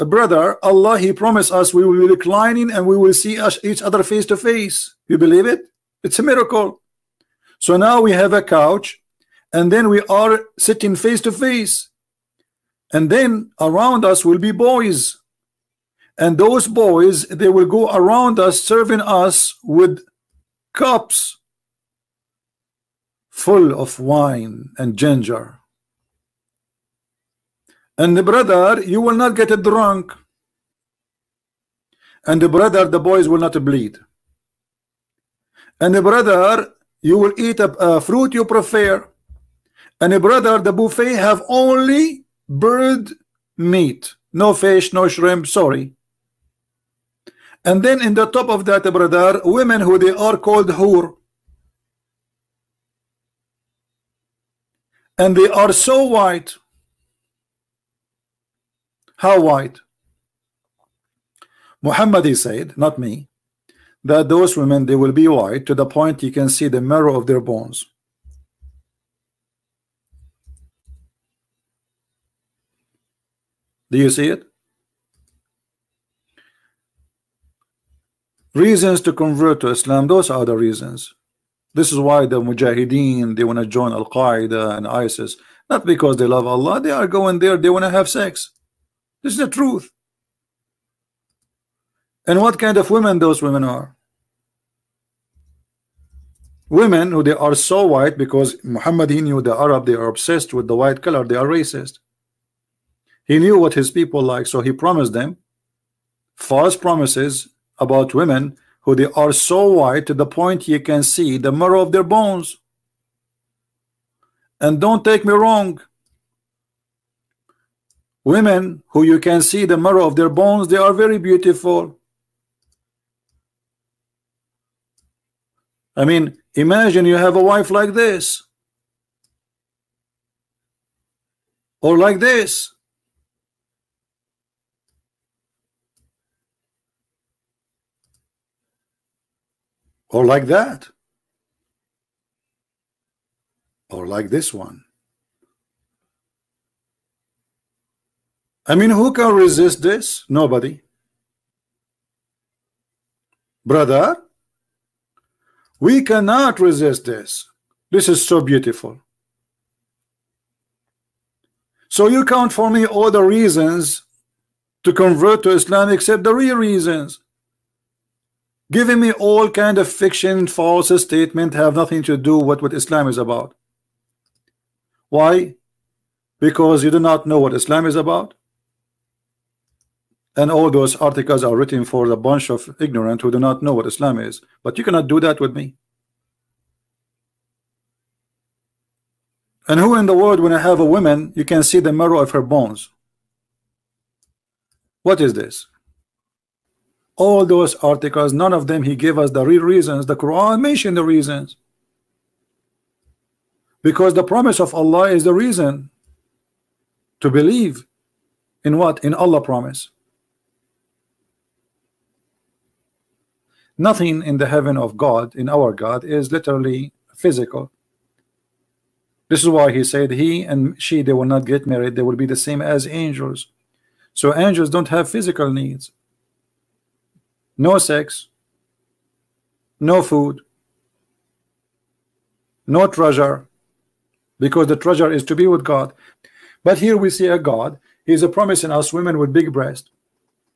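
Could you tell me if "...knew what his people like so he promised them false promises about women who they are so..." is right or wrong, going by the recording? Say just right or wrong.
right.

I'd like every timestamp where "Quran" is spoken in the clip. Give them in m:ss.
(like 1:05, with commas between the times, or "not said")
3:20.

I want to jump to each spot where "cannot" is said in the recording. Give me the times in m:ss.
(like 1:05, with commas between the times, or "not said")
2:36, 3:04.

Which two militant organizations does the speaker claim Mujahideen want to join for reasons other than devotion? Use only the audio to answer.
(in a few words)
Al Qaeda and ISIS.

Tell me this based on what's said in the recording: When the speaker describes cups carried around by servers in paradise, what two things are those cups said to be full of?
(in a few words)
Wine and ginger.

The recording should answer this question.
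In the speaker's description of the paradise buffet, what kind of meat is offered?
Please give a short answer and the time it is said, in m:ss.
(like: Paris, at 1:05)
Bird meat, at 0:42.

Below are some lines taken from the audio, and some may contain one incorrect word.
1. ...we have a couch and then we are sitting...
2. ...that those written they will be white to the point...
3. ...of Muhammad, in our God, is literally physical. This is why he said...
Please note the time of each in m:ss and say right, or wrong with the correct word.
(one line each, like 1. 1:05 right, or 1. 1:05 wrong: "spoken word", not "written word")
1. 0:08 right
2. 1:04 wrong: "women", not "written"
3. 3:34 wrong: "God", not "Muhammad".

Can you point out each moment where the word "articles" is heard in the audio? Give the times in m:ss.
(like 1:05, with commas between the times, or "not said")
3:00, 3:17.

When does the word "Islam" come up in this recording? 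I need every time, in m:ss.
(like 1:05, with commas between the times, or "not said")
1:19, 2:45, 2:52, 2:57, 3:03.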